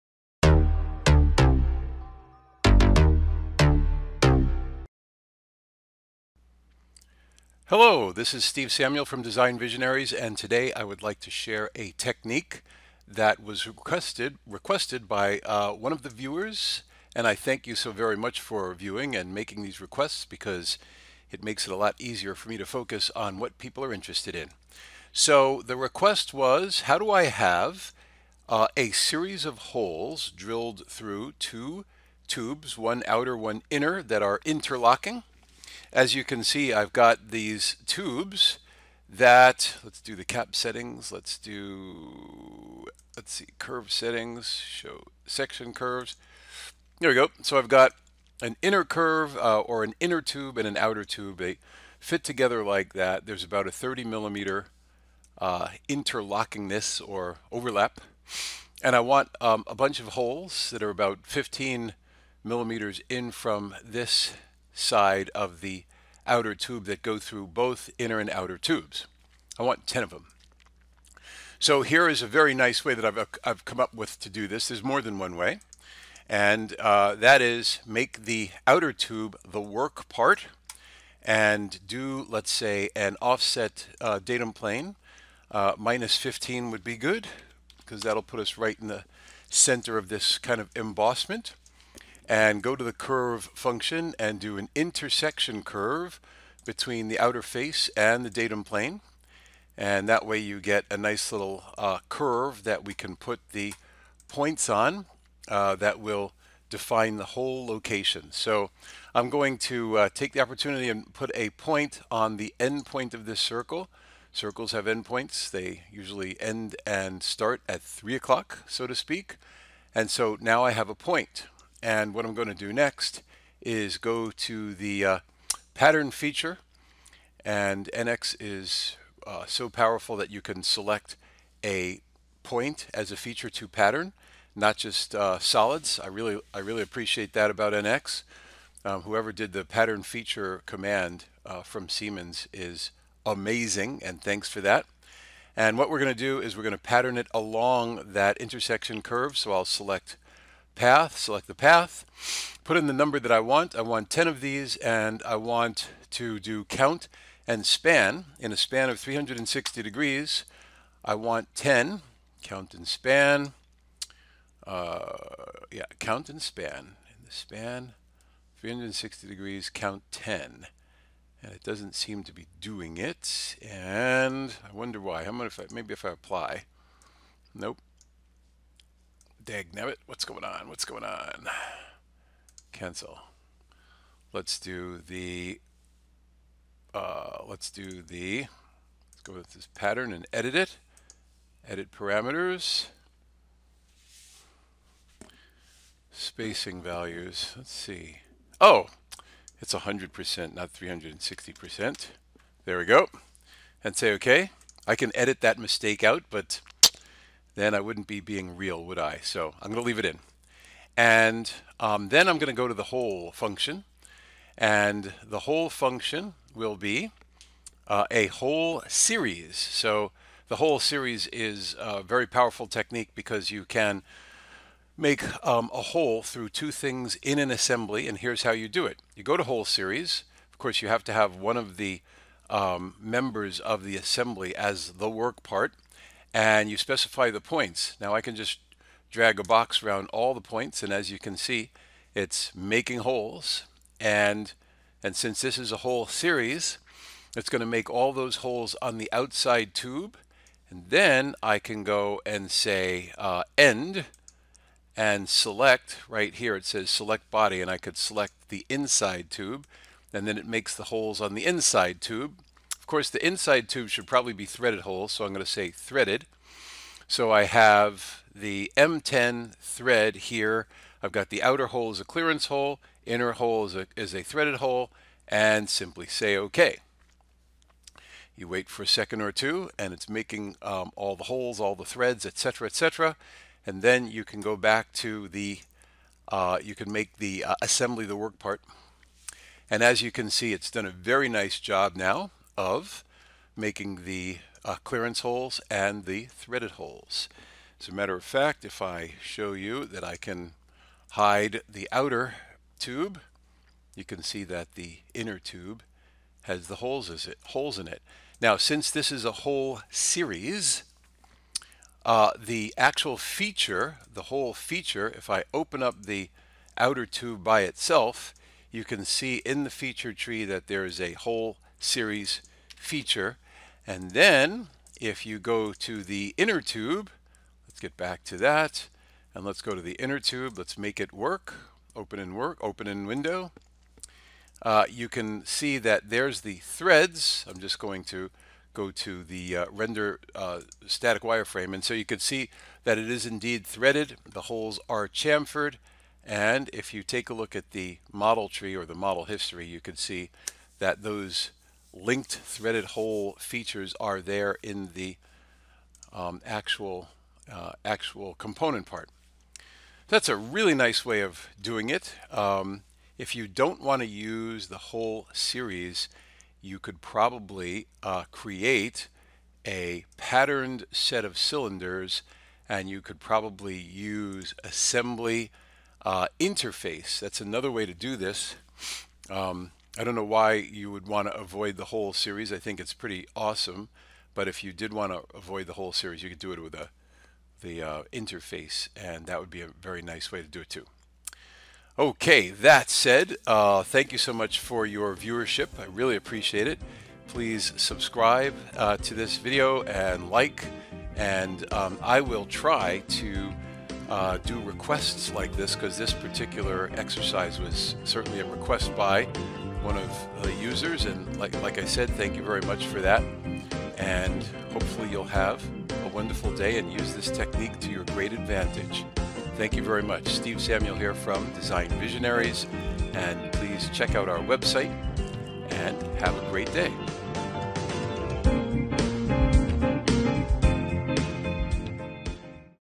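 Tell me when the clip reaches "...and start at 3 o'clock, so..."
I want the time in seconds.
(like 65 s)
116 s.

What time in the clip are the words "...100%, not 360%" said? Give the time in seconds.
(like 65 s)
199 s.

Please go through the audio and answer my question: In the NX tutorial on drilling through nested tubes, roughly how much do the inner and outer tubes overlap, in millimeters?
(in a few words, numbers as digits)
30 millimeters.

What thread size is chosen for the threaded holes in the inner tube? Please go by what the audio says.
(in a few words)
M10.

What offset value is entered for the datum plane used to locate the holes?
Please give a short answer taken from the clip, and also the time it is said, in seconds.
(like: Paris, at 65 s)
-15, at 85 s.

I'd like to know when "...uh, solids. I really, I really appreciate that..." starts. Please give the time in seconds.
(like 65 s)
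135 s.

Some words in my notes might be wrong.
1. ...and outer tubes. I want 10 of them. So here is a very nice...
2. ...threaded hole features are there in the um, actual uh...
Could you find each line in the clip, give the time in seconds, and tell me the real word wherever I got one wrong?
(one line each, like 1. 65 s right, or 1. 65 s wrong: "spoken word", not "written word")
1. 68 s right
2. 352 s right.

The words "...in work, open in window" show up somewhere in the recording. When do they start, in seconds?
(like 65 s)
332 s.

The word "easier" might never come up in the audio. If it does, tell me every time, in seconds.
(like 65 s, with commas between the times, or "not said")
21 s.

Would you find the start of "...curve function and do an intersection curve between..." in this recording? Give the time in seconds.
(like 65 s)
92 s.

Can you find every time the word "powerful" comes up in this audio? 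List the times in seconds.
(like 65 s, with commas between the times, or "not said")
129 s, 222 s.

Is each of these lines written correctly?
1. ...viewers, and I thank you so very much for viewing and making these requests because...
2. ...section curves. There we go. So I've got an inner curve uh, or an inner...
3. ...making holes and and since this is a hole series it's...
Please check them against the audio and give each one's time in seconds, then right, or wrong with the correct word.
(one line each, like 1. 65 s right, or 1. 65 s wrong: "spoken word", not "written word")
1. 16 s right
2. 45 s right
3. 242 s right.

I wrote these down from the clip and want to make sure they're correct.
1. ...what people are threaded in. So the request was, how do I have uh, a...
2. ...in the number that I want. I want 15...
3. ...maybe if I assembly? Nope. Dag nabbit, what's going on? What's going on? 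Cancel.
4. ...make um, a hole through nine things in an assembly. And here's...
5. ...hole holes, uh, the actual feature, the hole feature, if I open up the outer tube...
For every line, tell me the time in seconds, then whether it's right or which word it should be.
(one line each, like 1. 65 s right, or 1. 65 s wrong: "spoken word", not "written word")
1. 23 s wrong: "interested", not "threaded"
2. 152 s wrong: "10", not "15"
3. 175 s wrong: "apply", not "assembly"
4. 224 s wrong: "two", not "nine"
5. 309 s wrong: "series", not "holes".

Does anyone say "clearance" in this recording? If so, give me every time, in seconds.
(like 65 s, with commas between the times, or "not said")
272 s, 294 s.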